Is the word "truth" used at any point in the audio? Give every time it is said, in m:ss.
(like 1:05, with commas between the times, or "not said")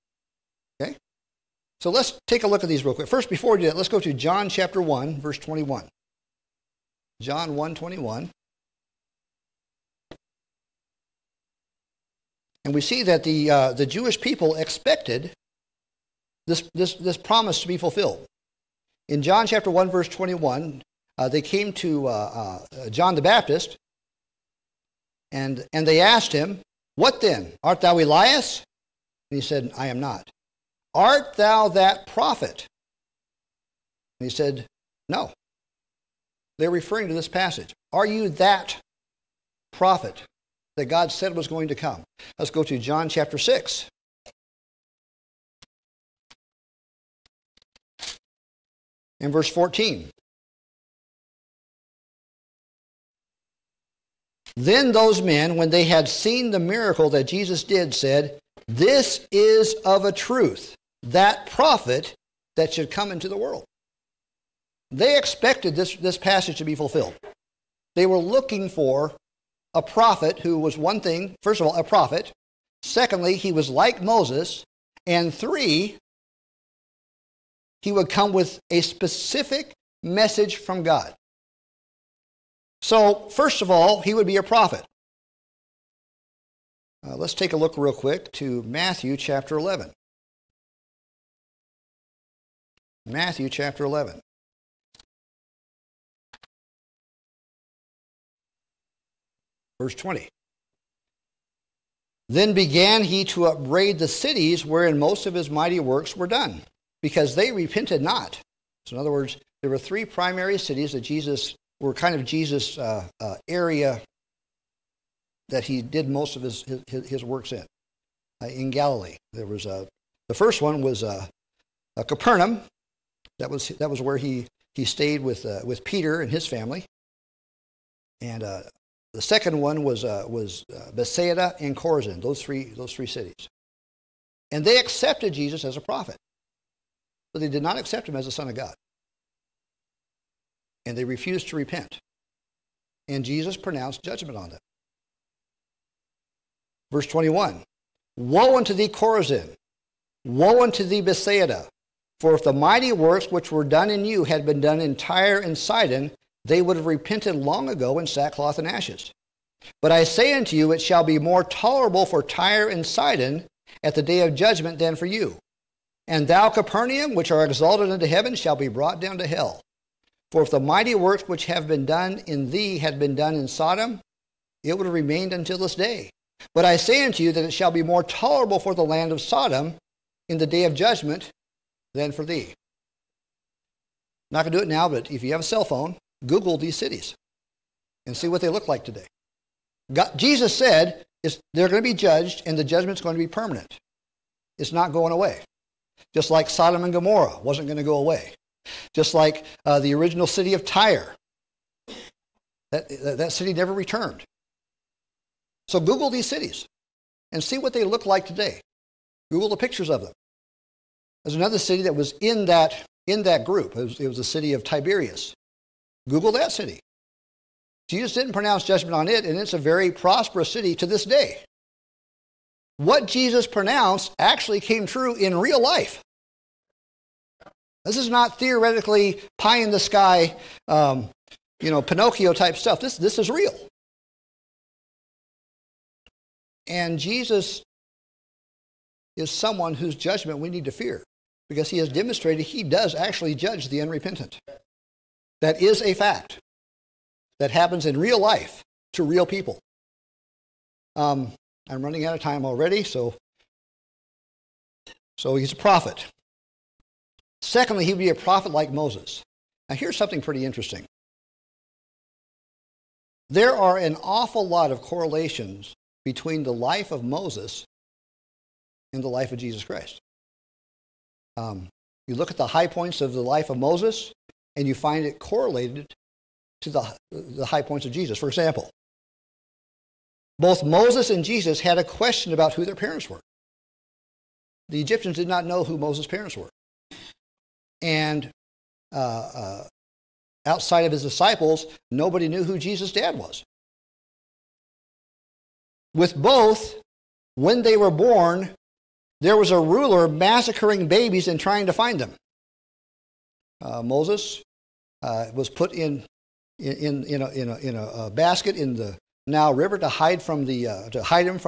1:00.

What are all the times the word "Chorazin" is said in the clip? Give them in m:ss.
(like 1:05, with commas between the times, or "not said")
2:11, 2:28.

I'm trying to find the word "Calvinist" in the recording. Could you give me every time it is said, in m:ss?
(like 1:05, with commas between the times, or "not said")
not said.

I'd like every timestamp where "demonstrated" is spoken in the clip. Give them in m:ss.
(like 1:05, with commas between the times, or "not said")
4:01.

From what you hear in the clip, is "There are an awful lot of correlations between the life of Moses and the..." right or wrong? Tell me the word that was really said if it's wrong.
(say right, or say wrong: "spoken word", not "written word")
right.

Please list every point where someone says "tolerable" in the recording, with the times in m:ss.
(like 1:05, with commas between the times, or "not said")
2:41, 2:58.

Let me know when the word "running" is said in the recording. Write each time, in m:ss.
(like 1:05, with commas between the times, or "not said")
4:11.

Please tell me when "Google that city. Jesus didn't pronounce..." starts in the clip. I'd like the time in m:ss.
3:36.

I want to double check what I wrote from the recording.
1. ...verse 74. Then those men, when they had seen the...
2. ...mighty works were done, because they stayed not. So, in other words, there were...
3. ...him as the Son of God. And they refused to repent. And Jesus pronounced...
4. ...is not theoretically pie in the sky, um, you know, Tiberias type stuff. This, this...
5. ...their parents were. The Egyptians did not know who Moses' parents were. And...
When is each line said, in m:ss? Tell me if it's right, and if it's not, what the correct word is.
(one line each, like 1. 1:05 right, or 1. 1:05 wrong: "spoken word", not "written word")
1. 0:49 wrong: "14", not "74"
2. 1:45 wrong: "repented", not "stayed"
3. 2:18 right
4. 3:47 wrong: "Pinocchio", not "Tiberias"
5. 4:42 right.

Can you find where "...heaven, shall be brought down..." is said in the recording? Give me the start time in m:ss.
2:48.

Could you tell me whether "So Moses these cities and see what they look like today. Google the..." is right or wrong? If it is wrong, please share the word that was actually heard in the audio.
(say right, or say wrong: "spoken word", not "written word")
wrong: "Google", not "Moses".